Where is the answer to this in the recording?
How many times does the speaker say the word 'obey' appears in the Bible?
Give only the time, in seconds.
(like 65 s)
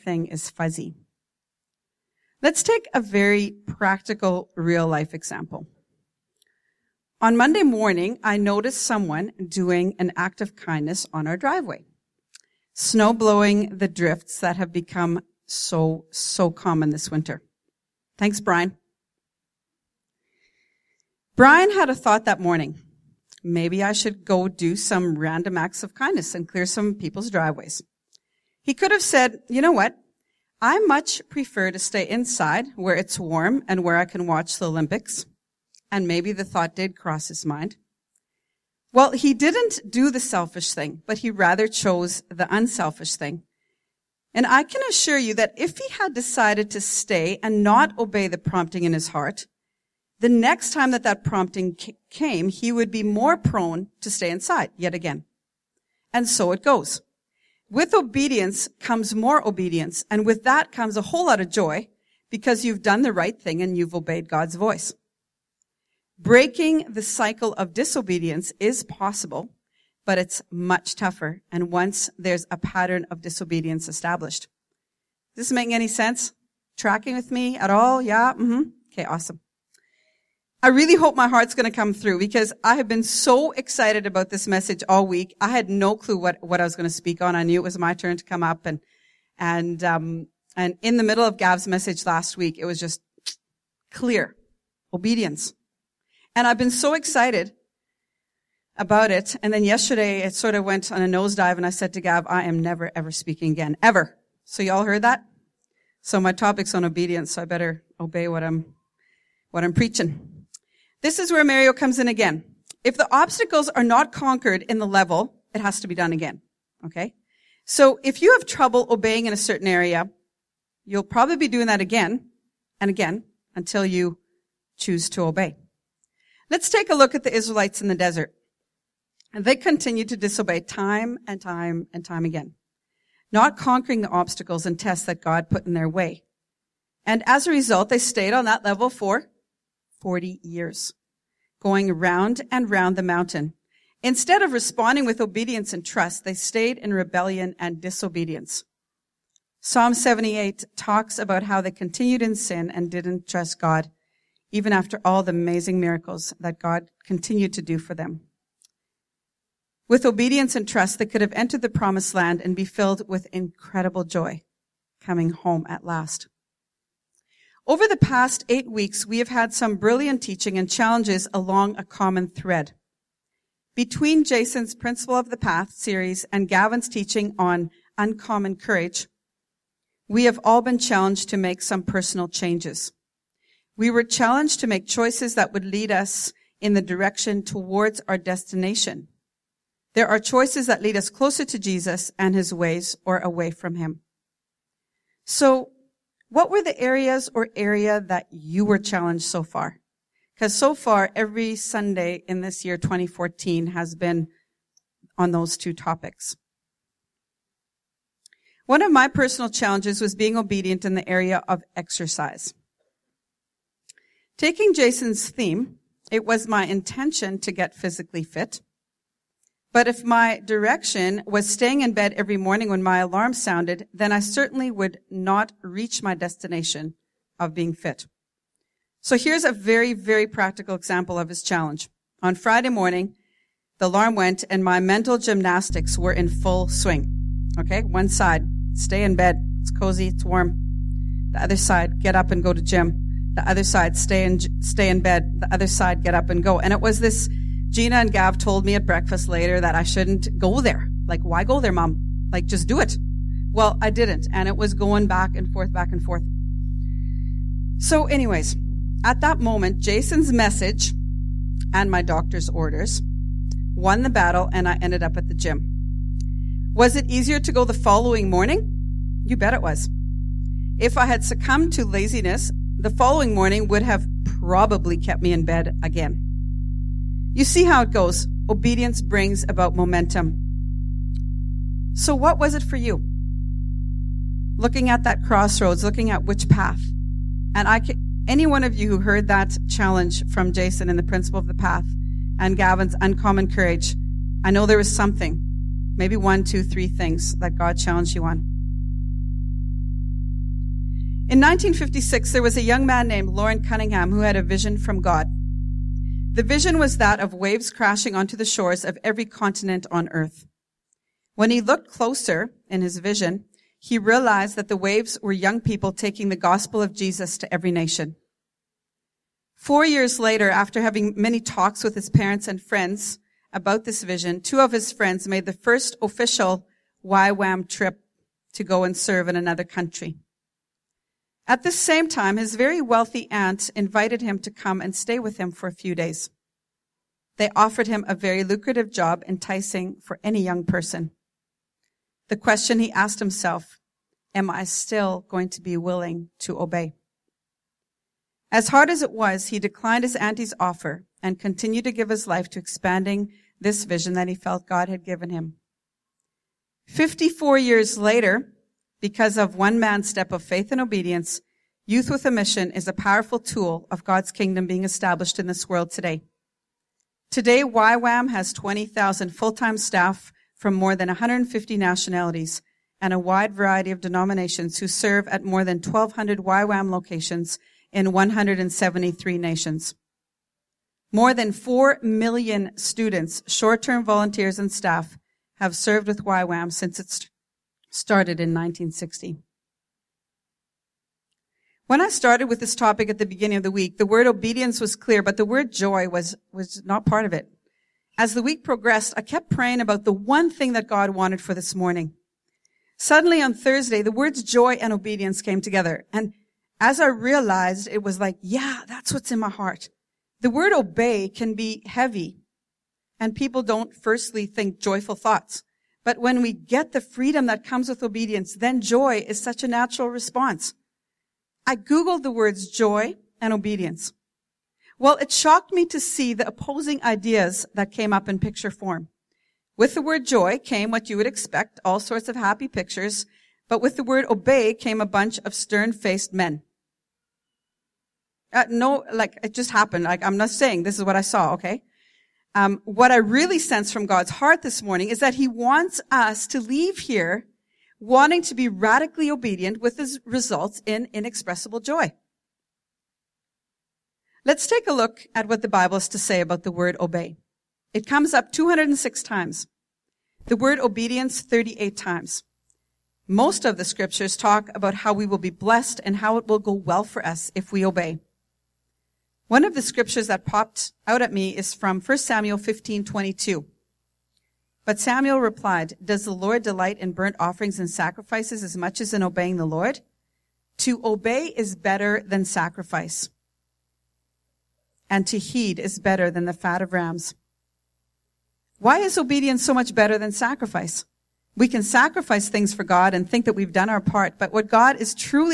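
458 s.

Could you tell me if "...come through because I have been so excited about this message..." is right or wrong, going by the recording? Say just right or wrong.
right.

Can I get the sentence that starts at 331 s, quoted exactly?
At the same time, his very wealthy aunt invited him to come and stay with him for a few days.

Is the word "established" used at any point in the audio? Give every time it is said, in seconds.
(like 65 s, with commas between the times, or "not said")
73 s, 364 s.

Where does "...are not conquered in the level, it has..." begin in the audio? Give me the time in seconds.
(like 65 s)
113 s.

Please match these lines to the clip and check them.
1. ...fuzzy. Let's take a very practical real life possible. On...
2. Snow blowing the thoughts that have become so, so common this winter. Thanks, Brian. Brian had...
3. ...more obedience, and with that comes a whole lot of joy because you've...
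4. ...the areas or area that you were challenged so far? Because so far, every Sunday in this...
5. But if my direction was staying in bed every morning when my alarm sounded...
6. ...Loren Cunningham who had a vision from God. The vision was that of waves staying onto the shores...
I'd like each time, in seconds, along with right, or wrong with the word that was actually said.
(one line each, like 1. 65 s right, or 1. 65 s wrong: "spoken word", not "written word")
1. 0 s wrong: "example", not "possible"
2. 12 s wrong: "drifts", not "thoughts"
3. 59 s right
4. 196 s right
5. 219 s right
6. 303 s wrong: "crashing", not "staying".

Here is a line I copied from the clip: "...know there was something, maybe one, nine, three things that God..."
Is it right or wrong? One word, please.
wrong.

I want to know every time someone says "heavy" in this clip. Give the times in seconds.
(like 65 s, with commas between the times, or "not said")
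411 s.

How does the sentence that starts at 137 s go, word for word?
And as a result, they stayed on that level for 40 years, going round and round the mountain.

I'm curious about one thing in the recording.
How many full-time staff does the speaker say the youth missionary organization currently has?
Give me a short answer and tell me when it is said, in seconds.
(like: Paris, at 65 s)
20,000, at 368 s.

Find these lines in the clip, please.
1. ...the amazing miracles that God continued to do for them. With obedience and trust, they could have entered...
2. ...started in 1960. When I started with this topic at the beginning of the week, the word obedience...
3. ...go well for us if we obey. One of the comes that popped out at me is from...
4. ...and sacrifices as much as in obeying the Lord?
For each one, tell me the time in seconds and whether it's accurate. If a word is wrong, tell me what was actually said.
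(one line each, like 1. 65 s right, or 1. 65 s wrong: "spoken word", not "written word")
1. 155 s right
2. 387 s right
3. 466 s wrong: "scriptures", not "comes"
4. 477 s right.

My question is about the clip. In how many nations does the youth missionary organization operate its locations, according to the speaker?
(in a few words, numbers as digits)
173.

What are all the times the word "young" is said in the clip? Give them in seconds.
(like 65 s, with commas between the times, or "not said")
302 s, 315 s, 340 s.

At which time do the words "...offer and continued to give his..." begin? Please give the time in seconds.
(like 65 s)
350 s.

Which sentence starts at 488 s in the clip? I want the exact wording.
Why is obedience so much better than sacrifice?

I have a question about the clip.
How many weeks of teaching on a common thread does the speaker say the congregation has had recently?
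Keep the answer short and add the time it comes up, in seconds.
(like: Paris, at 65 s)
8, at 168 s.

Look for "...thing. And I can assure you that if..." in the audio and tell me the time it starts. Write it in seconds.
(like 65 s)
43 s.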